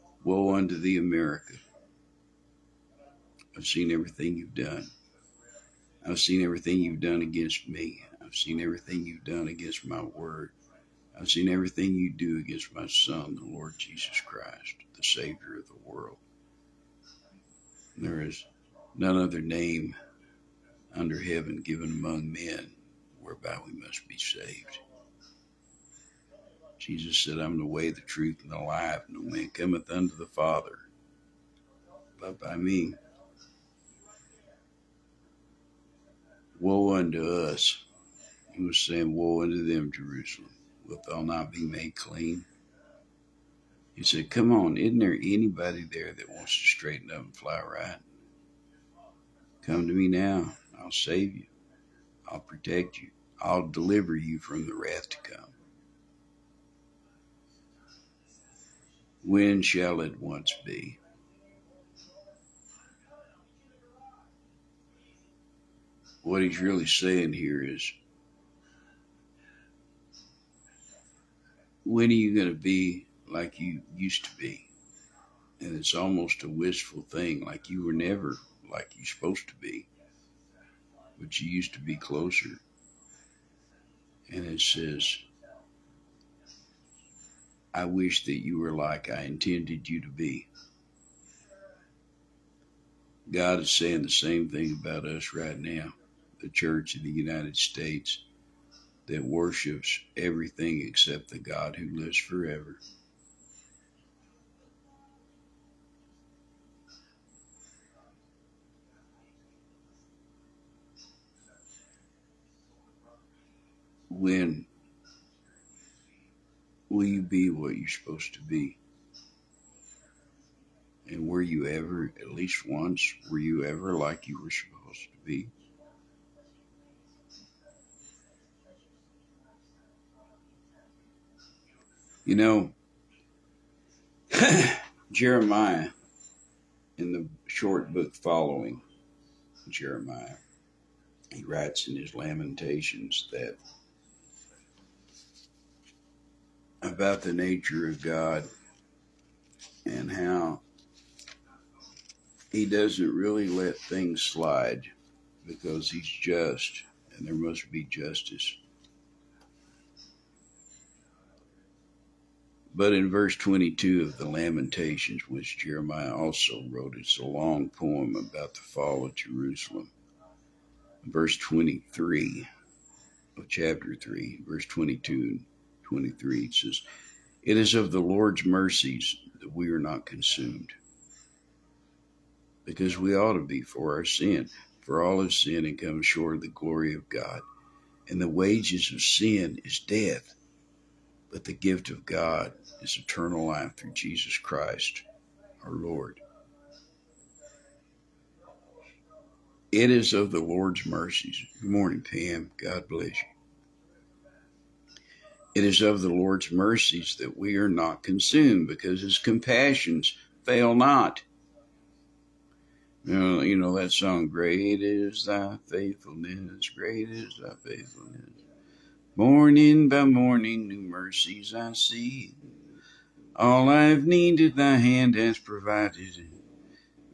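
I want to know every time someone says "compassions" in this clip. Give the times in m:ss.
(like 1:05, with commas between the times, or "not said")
3:29.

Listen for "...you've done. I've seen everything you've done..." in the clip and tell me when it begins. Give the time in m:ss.
0:04.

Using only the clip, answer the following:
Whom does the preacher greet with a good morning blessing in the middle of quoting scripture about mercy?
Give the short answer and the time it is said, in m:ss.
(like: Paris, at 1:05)
Pam, at 3:22.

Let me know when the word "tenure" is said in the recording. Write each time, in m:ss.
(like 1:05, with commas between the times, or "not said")
not said.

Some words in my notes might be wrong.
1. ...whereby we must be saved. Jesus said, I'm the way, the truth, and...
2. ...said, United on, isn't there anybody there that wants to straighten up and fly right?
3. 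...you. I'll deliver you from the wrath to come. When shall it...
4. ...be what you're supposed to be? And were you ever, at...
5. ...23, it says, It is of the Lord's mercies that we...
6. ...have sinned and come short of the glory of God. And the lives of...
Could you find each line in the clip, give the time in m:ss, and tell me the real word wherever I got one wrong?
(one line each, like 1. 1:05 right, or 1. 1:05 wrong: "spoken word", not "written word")
1. 0:23 right
2. 0:44 wrong: "Come", not "United"
3. 0:52 right
4. 1:57 right
5. 2:55 right
6. 3:05 wrong: "wages", not "lives".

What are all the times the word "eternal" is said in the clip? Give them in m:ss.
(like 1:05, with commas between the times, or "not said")
3:12.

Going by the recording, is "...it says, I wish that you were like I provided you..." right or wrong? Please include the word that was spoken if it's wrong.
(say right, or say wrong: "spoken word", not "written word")
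wrong: "intended", not "provided".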